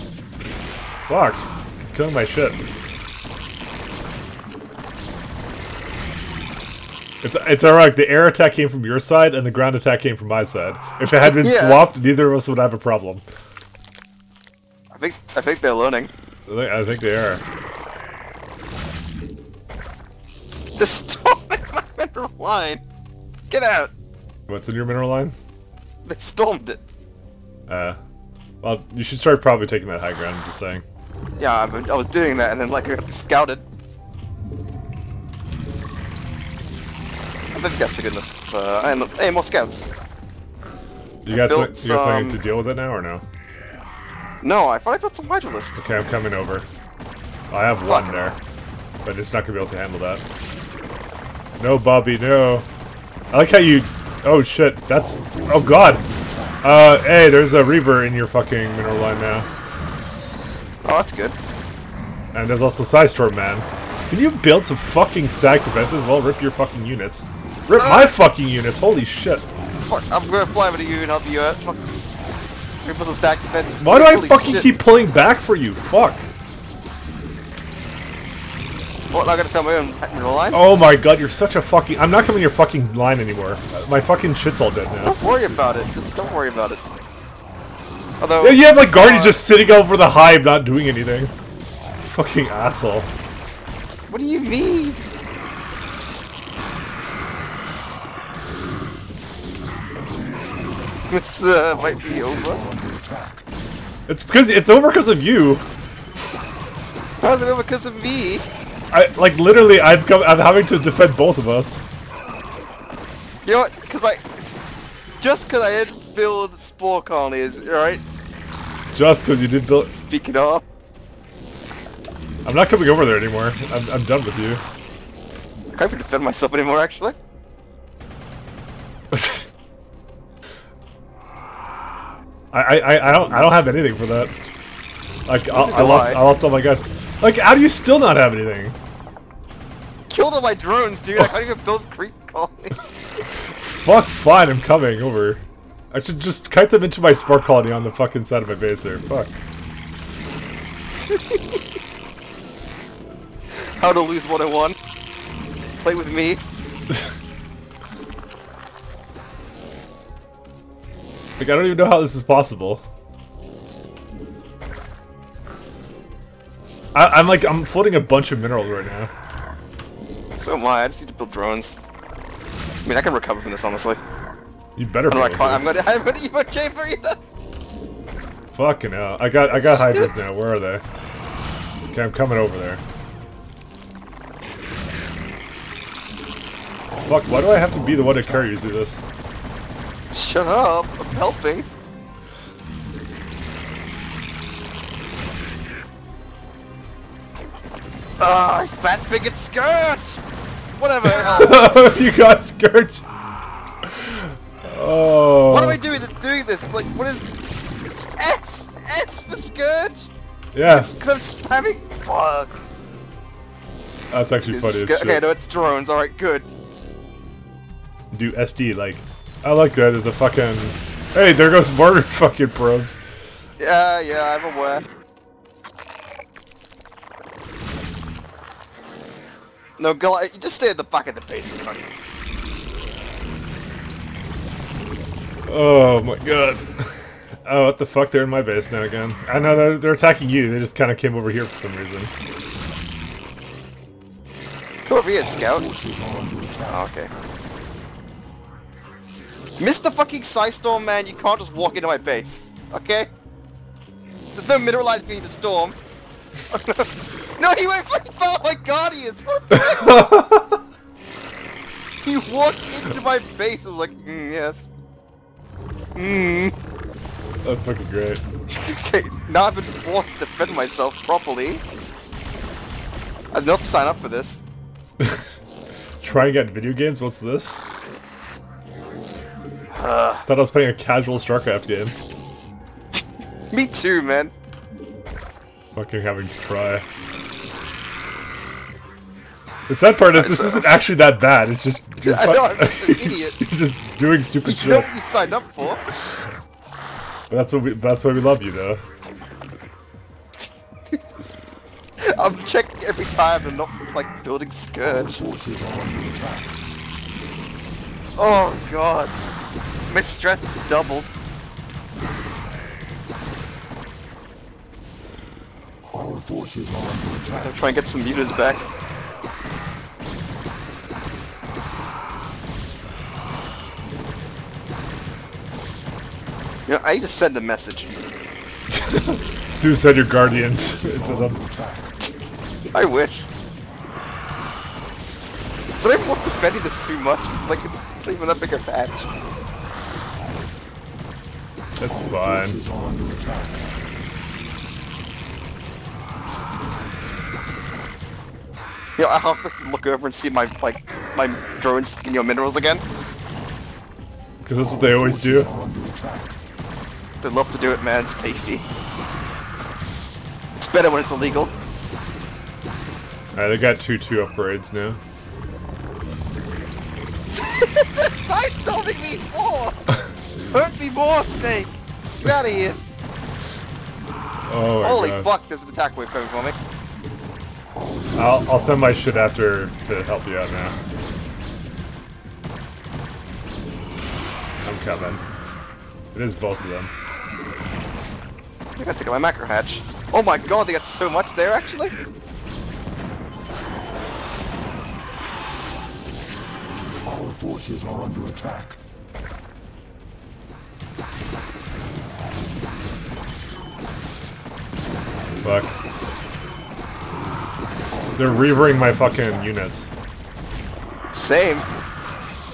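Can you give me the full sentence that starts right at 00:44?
No, I thought I built some hydralisks.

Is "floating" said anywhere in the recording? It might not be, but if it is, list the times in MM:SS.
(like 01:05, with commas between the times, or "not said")
02:47.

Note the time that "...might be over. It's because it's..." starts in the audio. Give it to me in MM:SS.
01:41.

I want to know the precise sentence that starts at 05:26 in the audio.
You know, I just send a message.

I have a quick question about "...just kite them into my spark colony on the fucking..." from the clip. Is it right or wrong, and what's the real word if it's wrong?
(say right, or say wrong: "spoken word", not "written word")
right.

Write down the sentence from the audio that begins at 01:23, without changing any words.
My fucking shit's all dead now.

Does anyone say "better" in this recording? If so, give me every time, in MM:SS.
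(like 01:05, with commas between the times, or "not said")
02:54, 06:00.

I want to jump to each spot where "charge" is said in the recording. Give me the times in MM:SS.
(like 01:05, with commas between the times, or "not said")
not said.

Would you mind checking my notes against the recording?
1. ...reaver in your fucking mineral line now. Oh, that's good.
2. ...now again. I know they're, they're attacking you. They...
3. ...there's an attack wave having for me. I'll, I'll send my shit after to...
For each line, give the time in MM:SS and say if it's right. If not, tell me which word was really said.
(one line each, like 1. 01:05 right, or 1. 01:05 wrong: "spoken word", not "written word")
1. 00:57 right
2. 03:58 right
3. 06:15 wrong: "coming", not "having".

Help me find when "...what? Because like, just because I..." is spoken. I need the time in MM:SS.
01:53.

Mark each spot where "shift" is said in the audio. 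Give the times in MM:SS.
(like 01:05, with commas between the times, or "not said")
not said.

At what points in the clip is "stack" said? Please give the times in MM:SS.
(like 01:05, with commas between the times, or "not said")
01:05, 01:13.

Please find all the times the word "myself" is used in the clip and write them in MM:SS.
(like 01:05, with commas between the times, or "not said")
02:06, 04:30.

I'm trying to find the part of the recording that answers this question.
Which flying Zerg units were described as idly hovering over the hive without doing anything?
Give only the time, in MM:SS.
01:28.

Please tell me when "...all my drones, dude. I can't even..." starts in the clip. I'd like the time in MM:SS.
02:20.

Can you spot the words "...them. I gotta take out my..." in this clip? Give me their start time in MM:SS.
06:26.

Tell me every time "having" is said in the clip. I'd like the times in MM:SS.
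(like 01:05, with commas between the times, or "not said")
01:50, 04:46.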